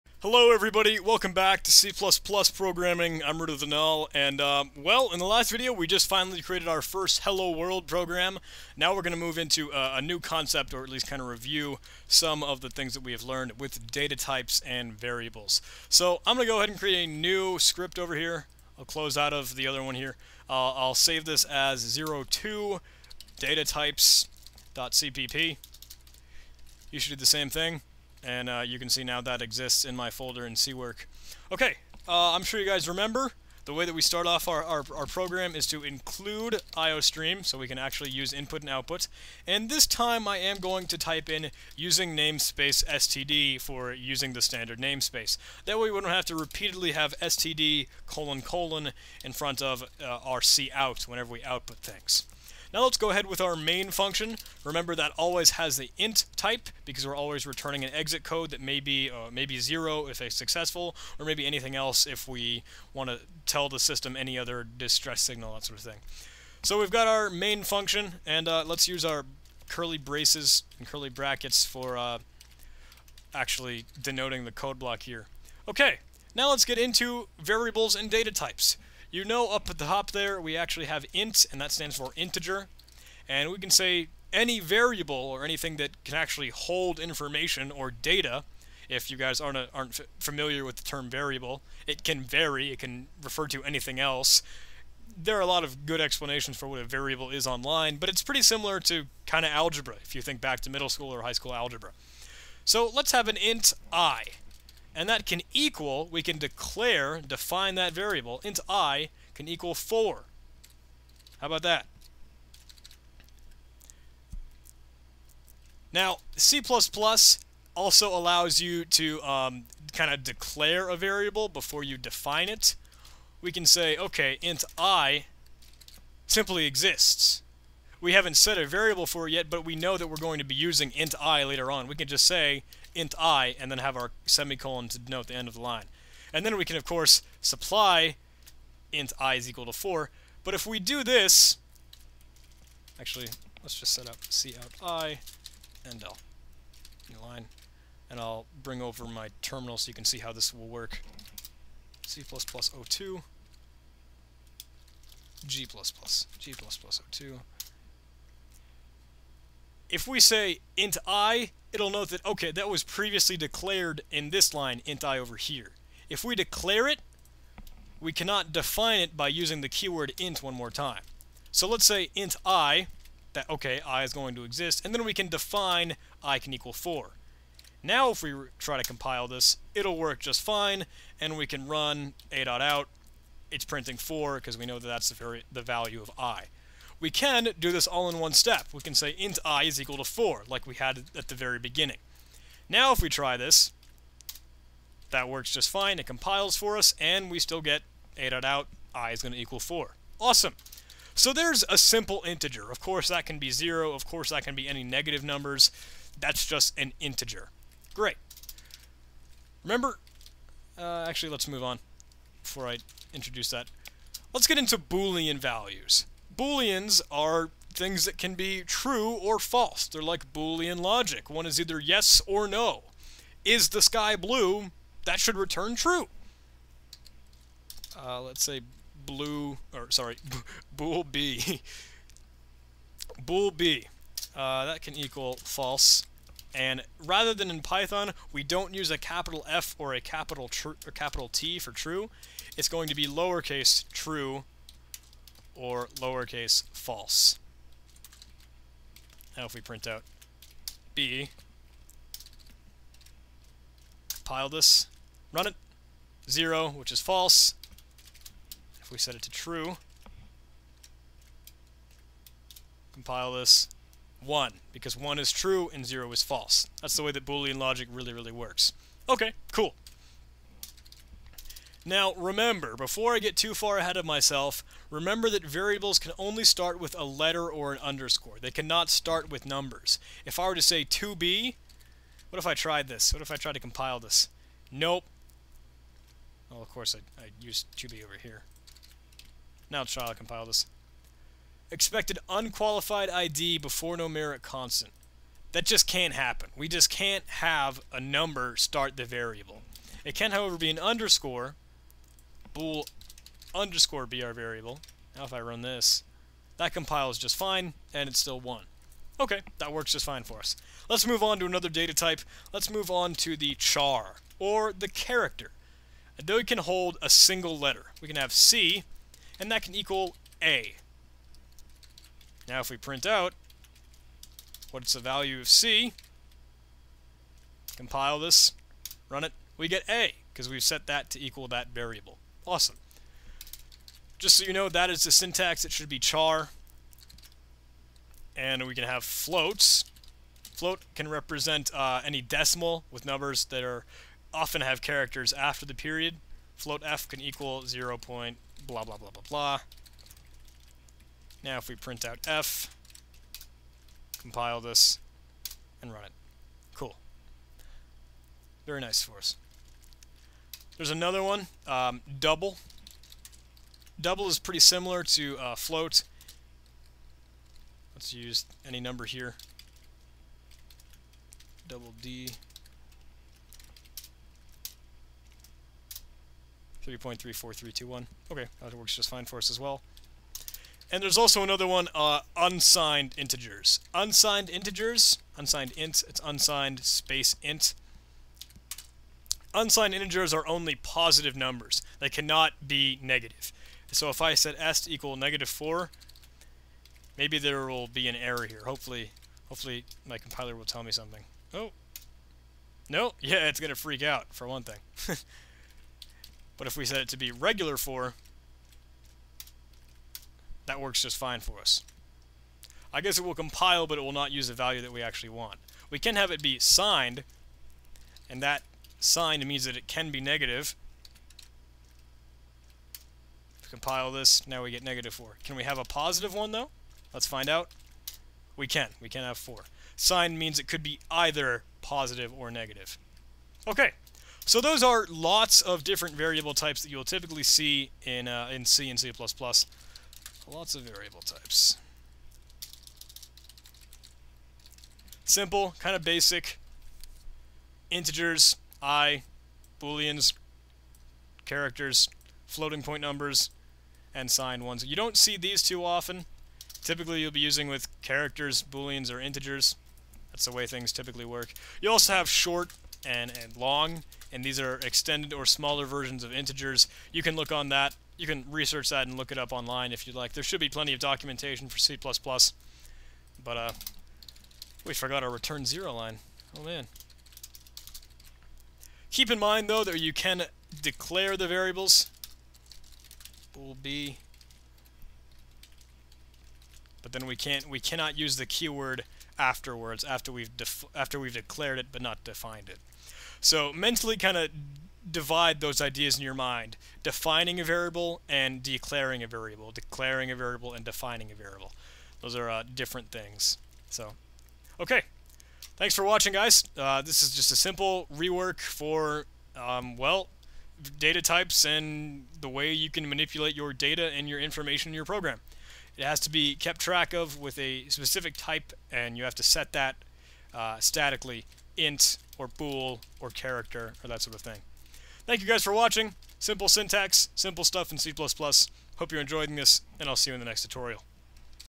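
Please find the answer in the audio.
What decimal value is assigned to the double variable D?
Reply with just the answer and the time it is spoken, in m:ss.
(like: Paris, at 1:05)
3.34321, at 6:16.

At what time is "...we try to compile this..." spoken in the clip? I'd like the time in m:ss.
2:58.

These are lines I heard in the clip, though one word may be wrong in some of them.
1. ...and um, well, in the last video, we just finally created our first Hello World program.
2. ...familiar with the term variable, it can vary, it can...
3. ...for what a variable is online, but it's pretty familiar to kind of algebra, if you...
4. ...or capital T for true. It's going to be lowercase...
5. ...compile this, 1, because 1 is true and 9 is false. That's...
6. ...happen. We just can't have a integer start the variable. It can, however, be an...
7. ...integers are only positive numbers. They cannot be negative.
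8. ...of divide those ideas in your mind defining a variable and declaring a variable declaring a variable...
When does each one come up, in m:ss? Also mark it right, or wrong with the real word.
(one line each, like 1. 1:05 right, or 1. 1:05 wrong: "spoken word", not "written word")
1. 0:04 right
2. 1:30 right
3. 1:36 wrong: "similar", not "familiar"
4. 4:00 right
5. 4:22 wrong: "0", not "9"
6. 4:56 wrong: "number", not "integer"
7. 6:29 right
8. 8:14 right.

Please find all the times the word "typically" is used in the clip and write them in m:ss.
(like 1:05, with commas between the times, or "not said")
7:17, 7:36, 7:40.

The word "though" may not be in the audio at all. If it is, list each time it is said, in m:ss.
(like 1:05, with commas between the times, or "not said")
5:16, 7:06, 7:59.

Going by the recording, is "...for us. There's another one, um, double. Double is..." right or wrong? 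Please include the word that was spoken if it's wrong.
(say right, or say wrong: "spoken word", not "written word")
right.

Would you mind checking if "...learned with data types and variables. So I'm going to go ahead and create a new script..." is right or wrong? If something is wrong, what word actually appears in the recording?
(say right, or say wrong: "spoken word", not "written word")
right.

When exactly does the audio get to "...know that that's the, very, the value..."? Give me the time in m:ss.
3:04.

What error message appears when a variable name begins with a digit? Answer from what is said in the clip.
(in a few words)
Expected unqualified ID before numeric constant.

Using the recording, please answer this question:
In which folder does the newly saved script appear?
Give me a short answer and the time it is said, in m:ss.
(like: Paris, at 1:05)
C-Work, at 0:30.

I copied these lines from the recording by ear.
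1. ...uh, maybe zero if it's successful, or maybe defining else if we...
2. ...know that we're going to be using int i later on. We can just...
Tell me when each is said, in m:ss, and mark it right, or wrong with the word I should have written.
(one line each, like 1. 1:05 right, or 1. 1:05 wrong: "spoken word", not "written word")
1. 0:59 wrong: "anything", not "defining"
2. 2:09 right.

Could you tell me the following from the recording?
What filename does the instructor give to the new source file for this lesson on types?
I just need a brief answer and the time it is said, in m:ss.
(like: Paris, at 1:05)
02 data types.cpp, at 0:22.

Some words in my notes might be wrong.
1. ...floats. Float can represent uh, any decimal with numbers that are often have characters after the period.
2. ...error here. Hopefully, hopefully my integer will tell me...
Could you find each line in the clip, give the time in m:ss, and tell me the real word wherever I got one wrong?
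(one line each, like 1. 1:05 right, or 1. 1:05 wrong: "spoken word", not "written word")
1. 5:39 right
2. 6:38 wrong: "compiler", not "integer".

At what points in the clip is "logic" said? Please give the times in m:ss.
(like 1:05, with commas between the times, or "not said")
3:40, 4:27.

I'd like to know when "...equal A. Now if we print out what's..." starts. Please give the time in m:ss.
5:19.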